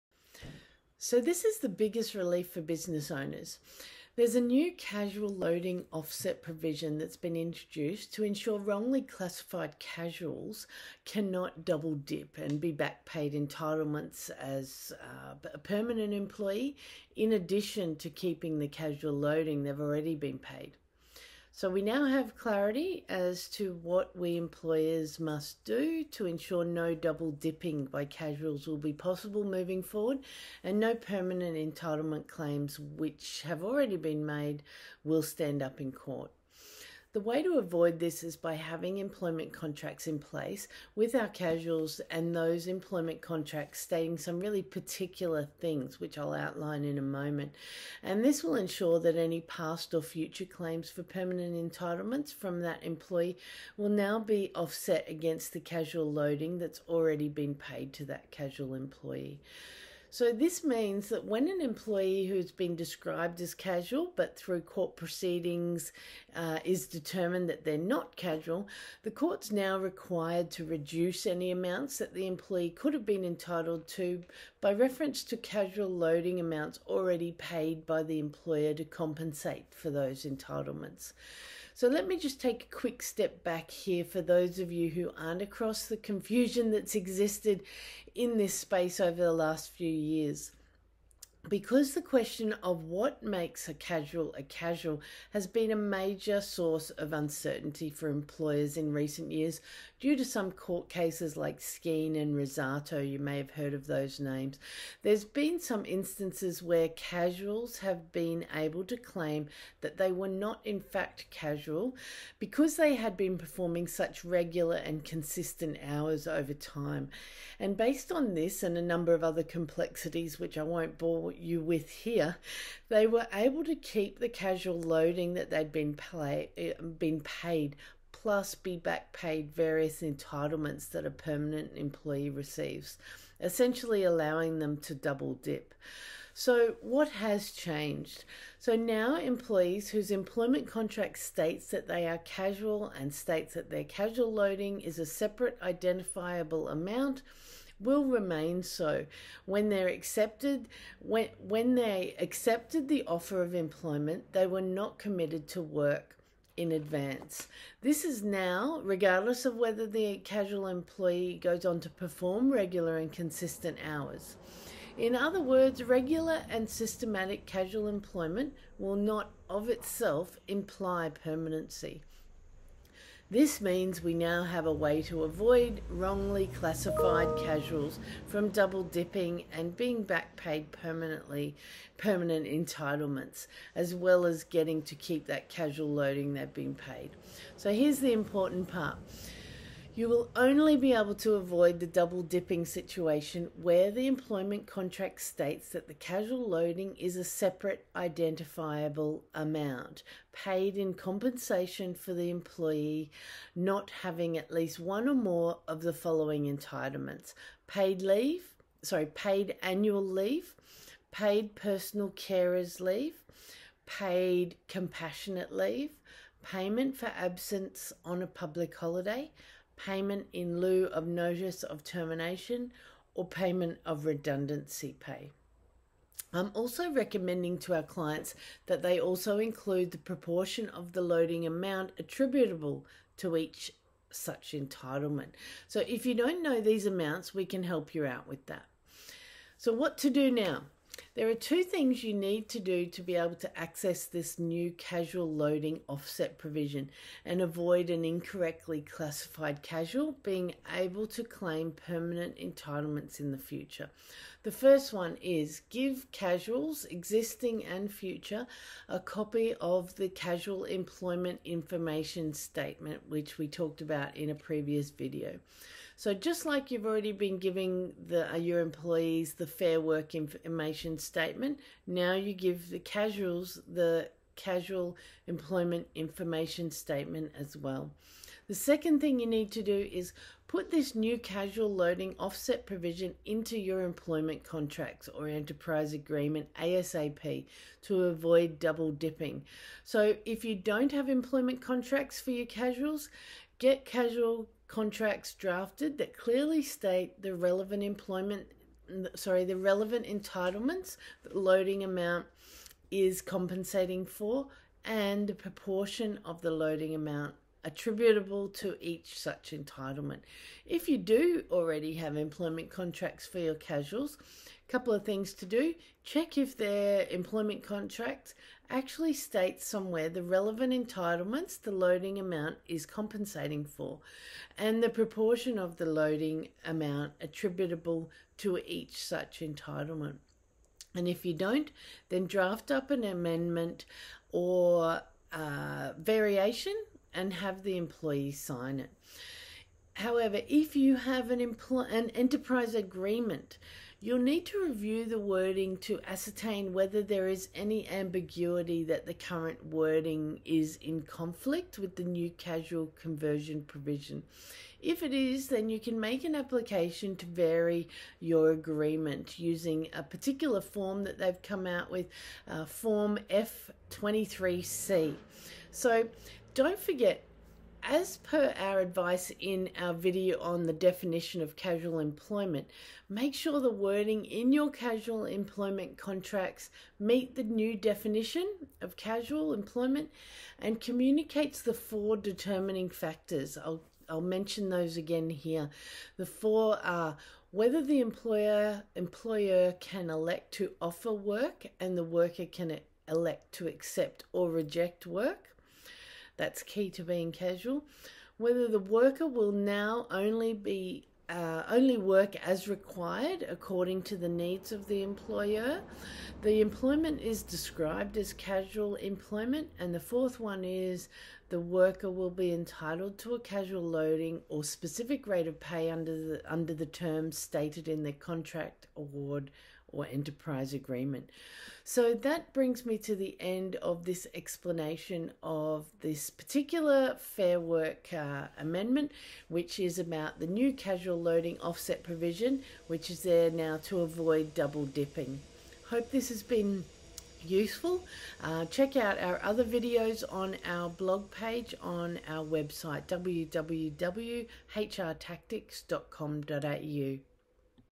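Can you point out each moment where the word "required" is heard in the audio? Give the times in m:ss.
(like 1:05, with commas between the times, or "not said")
1:09, 6:42.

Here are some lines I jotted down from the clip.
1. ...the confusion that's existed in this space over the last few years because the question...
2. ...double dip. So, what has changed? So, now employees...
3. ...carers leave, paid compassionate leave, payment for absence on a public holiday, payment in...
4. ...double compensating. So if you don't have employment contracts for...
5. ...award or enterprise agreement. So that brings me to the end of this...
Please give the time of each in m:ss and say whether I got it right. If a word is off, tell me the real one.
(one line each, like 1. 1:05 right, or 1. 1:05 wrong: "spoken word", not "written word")
1. 1:25 right
2. 2:14 right
3. 3:32 right
4. 4:48 wrong: "dipping", not "compensating"
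5. 6:58 right.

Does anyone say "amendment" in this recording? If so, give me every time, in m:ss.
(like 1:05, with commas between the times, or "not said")
5:33, 7:08.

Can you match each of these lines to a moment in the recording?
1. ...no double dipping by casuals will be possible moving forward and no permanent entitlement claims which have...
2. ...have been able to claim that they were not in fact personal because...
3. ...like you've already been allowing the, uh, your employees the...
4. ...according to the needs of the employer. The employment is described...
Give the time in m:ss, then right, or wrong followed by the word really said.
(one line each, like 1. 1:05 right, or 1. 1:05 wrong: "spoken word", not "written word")
1. 0:26 right
2. 1:47 wrong: "casual", not "personal"
3. 4:26 wrong: "giving", not "allowing"
4. 6:43 right.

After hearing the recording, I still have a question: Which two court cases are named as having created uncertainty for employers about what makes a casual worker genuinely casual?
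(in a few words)
Skene and Rossato.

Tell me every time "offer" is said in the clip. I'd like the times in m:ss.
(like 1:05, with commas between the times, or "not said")
2:33, 6:30.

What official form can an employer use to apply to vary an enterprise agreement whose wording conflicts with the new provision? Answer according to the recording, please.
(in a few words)
Form F23C.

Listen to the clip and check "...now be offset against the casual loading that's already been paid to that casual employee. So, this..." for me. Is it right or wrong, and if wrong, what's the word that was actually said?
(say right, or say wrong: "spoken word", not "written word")
right.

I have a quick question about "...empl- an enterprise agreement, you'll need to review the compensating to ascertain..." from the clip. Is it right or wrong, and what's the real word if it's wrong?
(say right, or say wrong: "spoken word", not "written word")
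wrong: "wording", not "compensating".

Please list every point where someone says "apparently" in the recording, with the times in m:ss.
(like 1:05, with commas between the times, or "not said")
not said.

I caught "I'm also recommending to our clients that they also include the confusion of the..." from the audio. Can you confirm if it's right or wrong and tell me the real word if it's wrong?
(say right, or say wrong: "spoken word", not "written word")
wrong: "proportion", not "confusion".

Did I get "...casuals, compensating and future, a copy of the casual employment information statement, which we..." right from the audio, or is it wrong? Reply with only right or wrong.
wrong.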